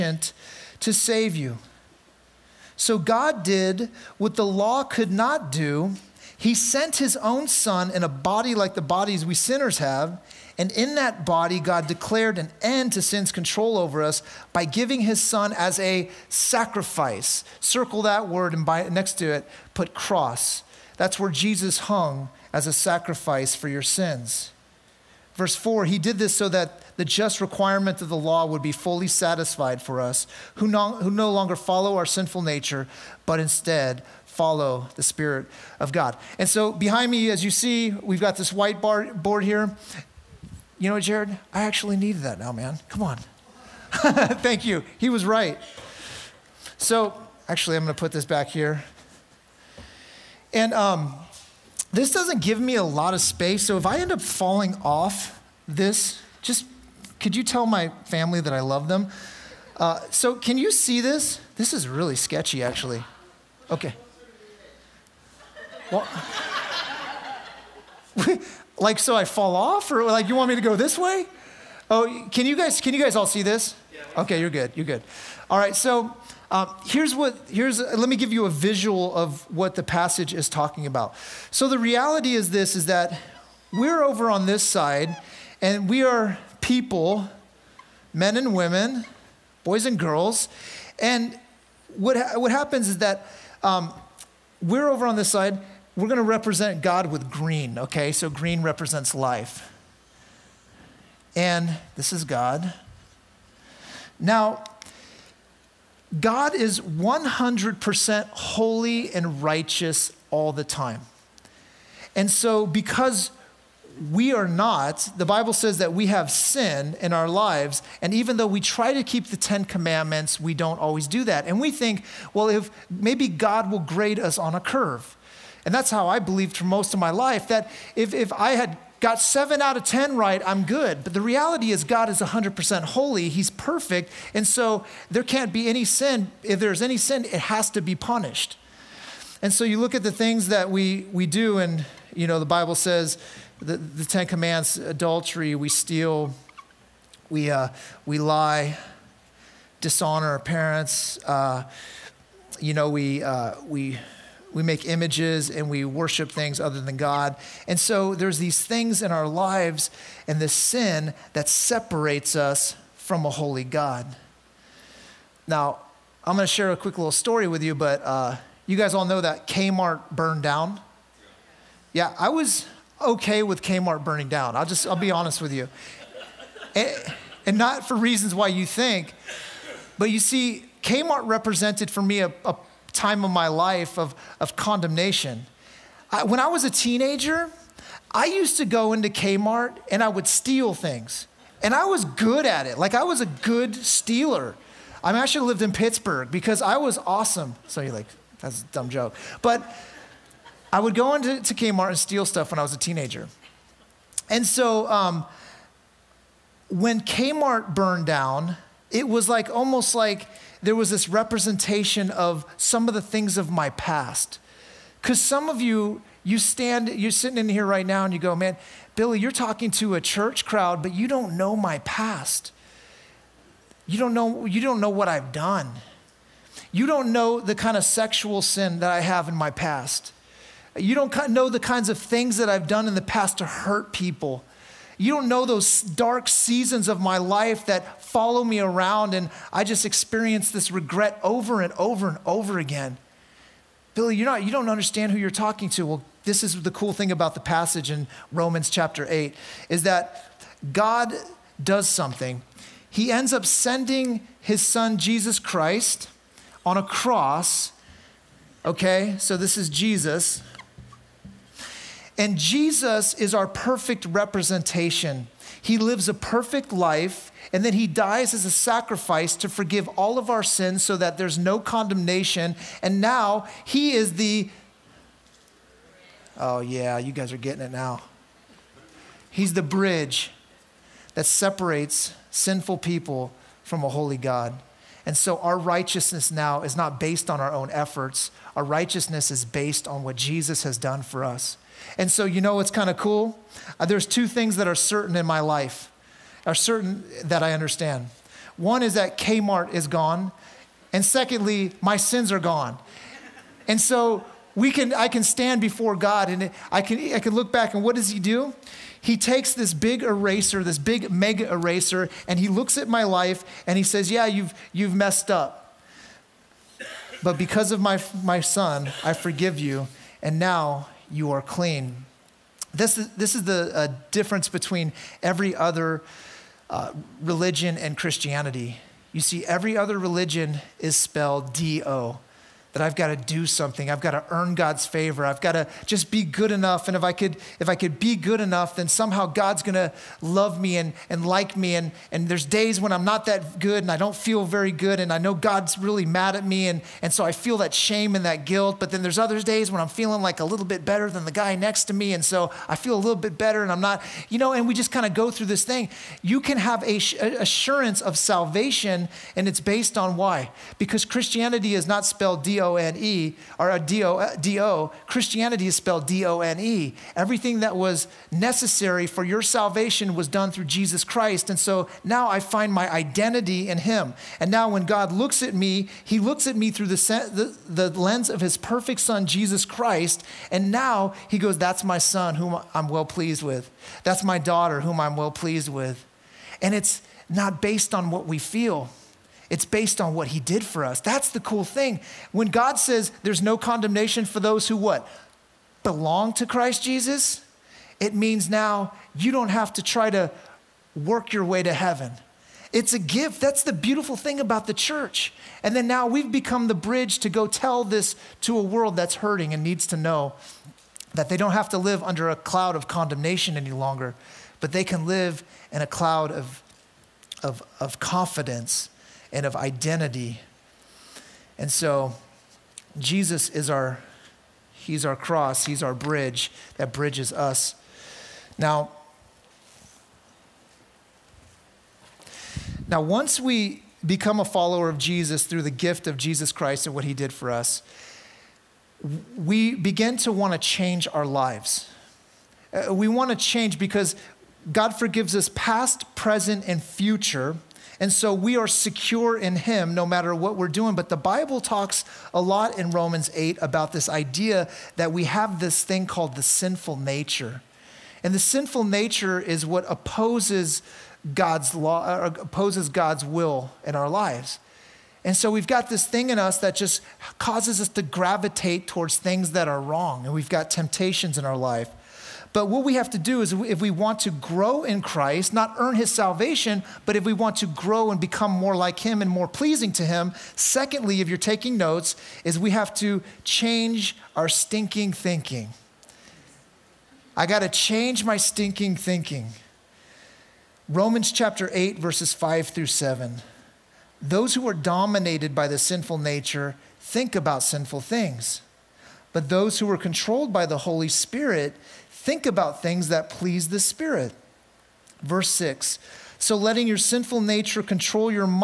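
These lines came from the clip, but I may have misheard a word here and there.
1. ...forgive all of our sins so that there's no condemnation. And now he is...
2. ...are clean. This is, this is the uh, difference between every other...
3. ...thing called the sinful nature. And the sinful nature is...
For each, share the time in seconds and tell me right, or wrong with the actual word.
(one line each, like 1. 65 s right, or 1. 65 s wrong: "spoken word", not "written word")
1. 269 s right
2. 321 s right
3. 455 s right.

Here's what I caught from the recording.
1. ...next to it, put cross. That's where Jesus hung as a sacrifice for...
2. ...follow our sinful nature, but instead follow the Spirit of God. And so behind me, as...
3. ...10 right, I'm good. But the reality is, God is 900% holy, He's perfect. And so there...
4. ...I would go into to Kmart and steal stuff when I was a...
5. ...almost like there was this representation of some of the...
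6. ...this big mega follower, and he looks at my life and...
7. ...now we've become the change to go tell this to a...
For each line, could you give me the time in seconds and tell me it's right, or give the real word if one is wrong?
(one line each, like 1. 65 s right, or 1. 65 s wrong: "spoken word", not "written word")
1. 18 s right
2. 31 s right
3. 129 s wrong: "100", not "900"
4. 200 s right
5. 209 s right
6. 310 s wrong: "eraser", not "follower"
7. 405 s wrong: "bridge", not "change".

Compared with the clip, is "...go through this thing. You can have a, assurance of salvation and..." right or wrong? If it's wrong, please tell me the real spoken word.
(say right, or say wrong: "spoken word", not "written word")
right.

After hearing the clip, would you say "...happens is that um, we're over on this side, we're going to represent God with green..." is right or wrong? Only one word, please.
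right.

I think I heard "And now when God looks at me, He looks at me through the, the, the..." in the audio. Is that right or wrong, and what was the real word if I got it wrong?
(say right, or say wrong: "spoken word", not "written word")
right.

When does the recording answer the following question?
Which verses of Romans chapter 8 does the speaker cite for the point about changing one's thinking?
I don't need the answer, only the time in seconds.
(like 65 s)
491 s.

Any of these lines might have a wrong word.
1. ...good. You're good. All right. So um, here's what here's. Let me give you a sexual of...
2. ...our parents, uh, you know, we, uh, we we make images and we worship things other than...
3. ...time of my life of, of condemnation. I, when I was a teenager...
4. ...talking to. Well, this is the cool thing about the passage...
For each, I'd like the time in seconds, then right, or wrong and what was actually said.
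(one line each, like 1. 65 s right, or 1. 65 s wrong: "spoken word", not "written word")
1. 74 s wrong: "visual", not "sexual"
2. 150 s right
3. 182 s right
4. 245 s right.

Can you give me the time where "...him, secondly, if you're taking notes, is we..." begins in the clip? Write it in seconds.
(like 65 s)
480 s.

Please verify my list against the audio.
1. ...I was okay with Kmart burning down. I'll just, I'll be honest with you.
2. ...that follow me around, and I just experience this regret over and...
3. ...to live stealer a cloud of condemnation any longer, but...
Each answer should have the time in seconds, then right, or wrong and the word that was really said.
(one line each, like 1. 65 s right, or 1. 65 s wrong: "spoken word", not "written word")
1. 172 s right
2. 237 s right
3. 411 s wrong: "under", not "stealer".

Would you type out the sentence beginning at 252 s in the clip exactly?
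He ends up sending his son Jesus Christ on a cross.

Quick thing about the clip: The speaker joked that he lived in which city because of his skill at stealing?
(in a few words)
Pittsburgh.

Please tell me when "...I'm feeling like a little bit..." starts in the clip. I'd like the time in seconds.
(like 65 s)
349 s.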